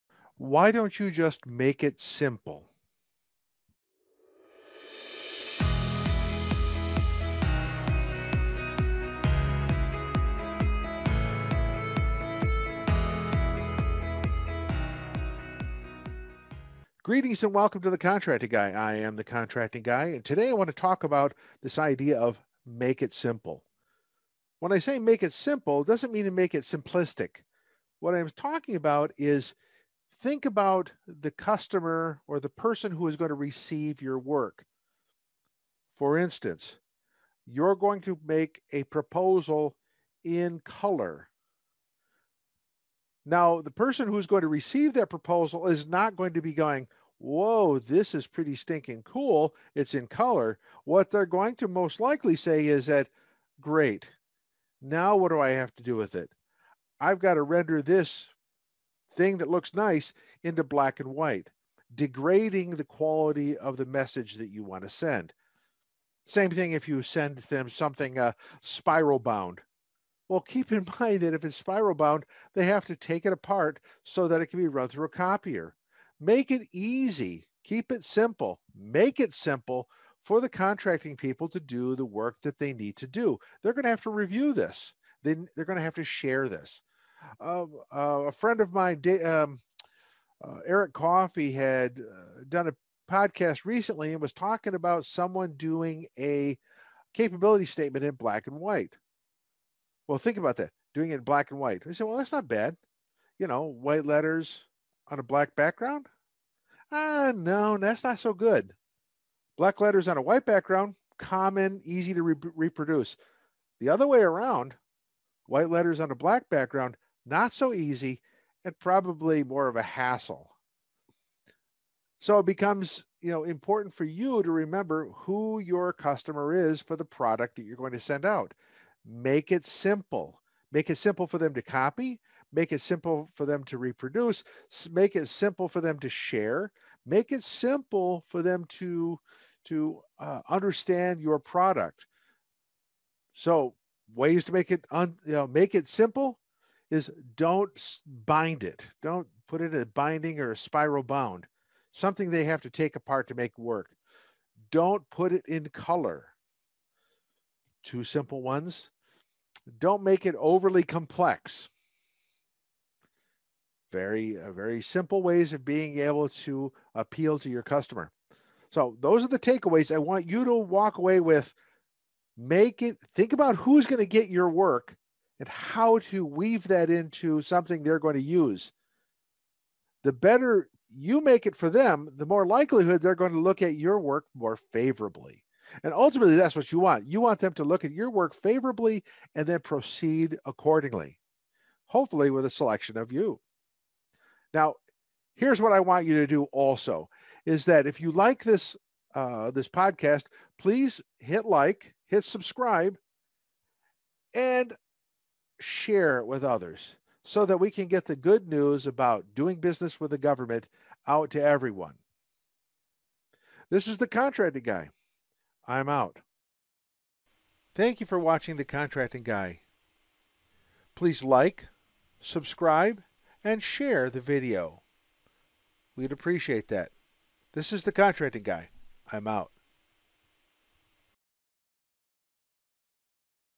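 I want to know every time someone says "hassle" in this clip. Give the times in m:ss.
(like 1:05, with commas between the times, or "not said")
1:59.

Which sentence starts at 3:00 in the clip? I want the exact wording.
The better you make it for them, the more likelihood they're going to look at your work more favorably.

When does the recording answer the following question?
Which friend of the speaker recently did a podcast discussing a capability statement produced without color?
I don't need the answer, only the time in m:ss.
1:30.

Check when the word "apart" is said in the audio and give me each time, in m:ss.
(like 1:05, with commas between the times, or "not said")
1:13, 2:32.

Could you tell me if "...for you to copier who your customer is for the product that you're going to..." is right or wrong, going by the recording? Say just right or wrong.
wrong.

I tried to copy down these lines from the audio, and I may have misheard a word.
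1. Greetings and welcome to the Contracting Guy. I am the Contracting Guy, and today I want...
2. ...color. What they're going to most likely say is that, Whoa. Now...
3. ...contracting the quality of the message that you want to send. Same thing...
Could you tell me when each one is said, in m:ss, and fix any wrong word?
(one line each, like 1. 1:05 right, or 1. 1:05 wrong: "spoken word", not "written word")
1. 0:17 right
2. 0:50 wrong: "Great", not "Whoa"
3. 1:01 wrong: "degrading", not "contracting".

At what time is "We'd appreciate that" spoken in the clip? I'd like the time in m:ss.
3:45.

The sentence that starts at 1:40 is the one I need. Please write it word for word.
Well, think about that doing it in black and white.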